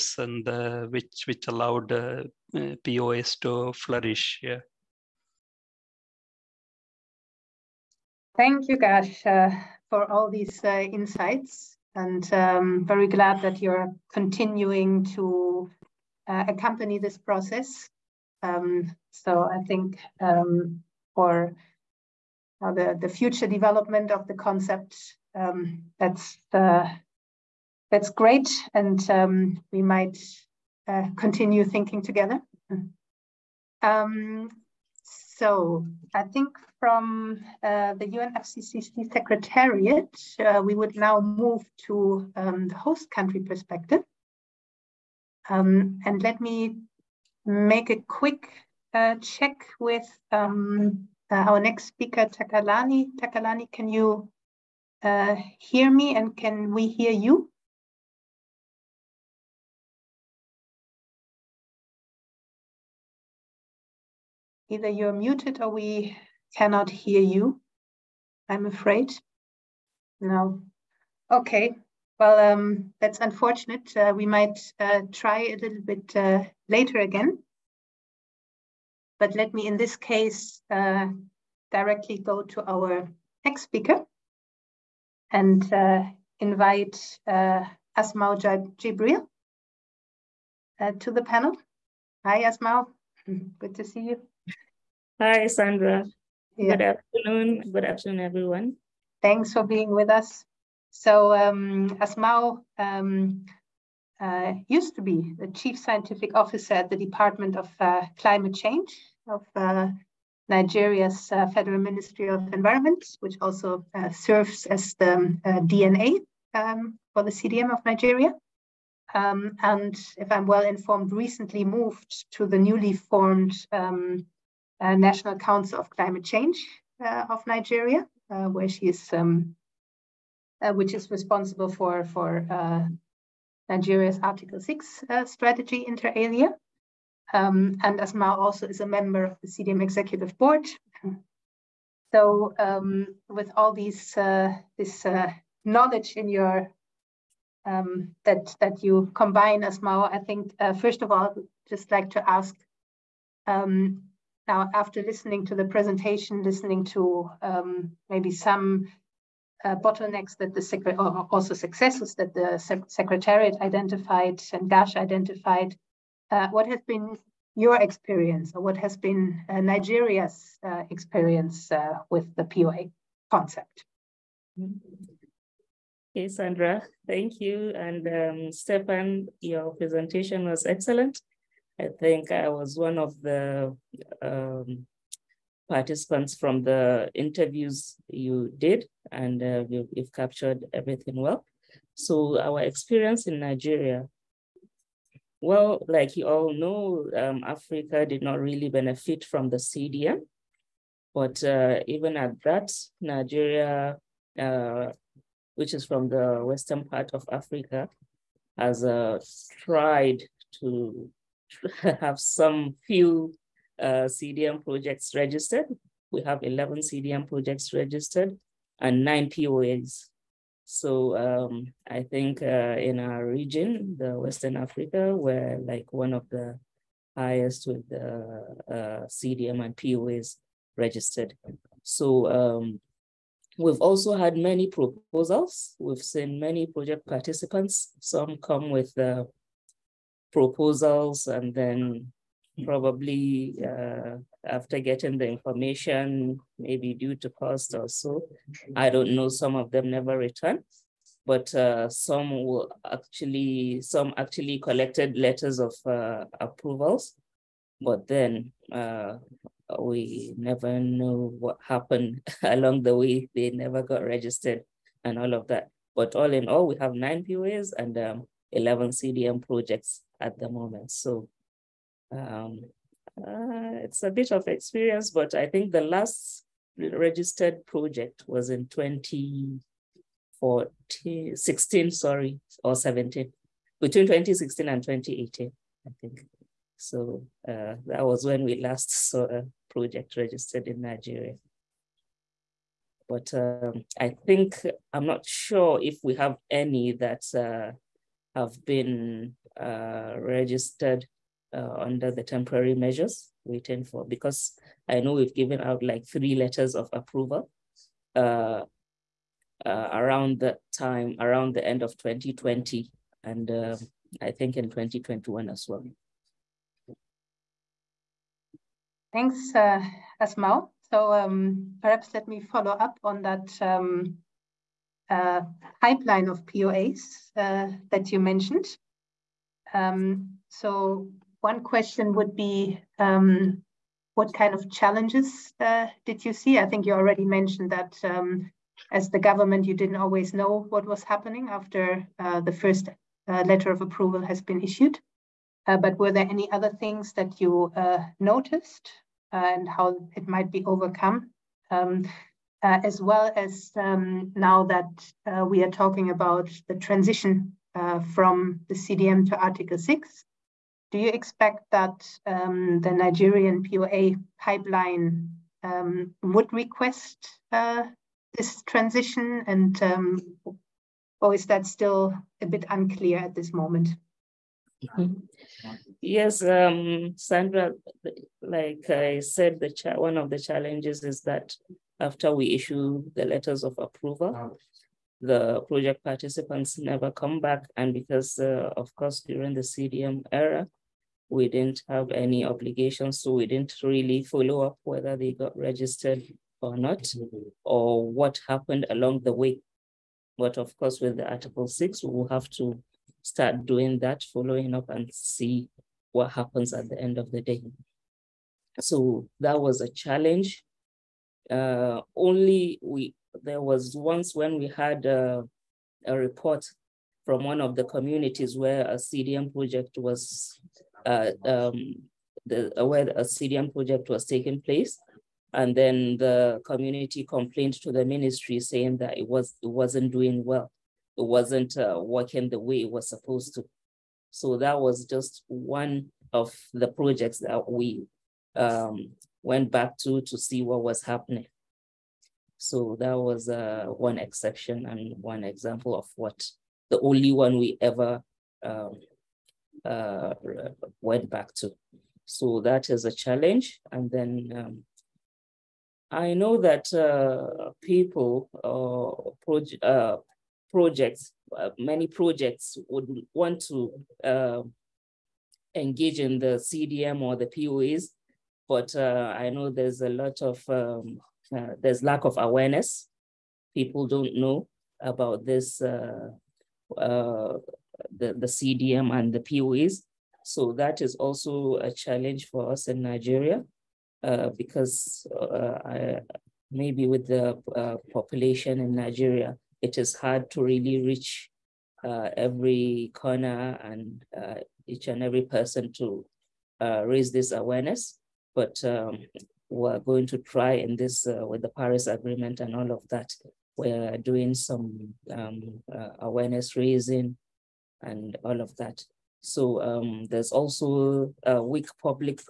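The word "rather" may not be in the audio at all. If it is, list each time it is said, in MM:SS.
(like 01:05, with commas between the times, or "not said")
not said.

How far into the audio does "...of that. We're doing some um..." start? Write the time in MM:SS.
08:22.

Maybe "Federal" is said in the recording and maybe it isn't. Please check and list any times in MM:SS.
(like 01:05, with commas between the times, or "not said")
01:51.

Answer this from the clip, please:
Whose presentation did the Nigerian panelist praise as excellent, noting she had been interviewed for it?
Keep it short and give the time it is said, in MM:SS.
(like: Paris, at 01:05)
Stefan, at 02:58.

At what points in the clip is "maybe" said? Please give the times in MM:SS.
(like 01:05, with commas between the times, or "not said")
02:38, 04:06, 08:06.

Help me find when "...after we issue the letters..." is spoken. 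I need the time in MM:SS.
06:22.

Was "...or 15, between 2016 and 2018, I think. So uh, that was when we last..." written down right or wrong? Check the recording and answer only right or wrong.
wrong.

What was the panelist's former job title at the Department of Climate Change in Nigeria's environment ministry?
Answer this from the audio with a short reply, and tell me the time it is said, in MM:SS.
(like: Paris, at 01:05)
Chief scientific officer, at 01:45.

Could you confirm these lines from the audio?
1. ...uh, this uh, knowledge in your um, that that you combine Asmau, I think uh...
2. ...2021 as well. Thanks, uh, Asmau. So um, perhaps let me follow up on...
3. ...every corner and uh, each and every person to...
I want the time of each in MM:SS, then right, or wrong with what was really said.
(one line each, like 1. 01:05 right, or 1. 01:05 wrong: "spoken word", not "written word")
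1. 02:24 right
2. 05:14 right
3. 08:12 right.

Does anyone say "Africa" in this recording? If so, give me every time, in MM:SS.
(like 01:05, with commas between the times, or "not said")
03:17, 03:27, 03:44.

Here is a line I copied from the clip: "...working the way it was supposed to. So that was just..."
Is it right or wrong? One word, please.
right.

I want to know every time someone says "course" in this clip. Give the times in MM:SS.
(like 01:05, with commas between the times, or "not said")
06:28, 06:40.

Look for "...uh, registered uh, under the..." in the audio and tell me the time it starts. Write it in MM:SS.
04:59.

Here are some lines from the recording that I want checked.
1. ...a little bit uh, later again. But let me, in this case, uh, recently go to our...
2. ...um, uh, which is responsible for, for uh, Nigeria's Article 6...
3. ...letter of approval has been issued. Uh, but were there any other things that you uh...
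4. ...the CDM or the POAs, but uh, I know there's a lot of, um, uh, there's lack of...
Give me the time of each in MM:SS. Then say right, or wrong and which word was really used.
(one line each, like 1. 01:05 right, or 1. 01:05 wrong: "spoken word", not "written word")
1. 01:15 wrong: "directly", not "recently"
2. 02:09 right
3. 05:43 right
4. 07:46 right.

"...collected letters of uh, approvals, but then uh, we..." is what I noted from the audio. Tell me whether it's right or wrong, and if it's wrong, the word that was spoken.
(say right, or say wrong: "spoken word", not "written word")
right.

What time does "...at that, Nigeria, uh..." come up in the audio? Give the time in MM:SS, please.
03:22.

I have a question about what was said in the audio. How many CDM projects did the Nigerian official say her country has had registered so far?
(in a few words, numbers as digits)
11.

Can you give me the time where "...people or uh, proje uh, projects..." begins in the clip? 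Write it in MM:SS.
07:37.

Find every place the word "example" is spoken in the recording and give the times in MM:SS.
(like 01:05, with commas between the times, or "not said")
07:25.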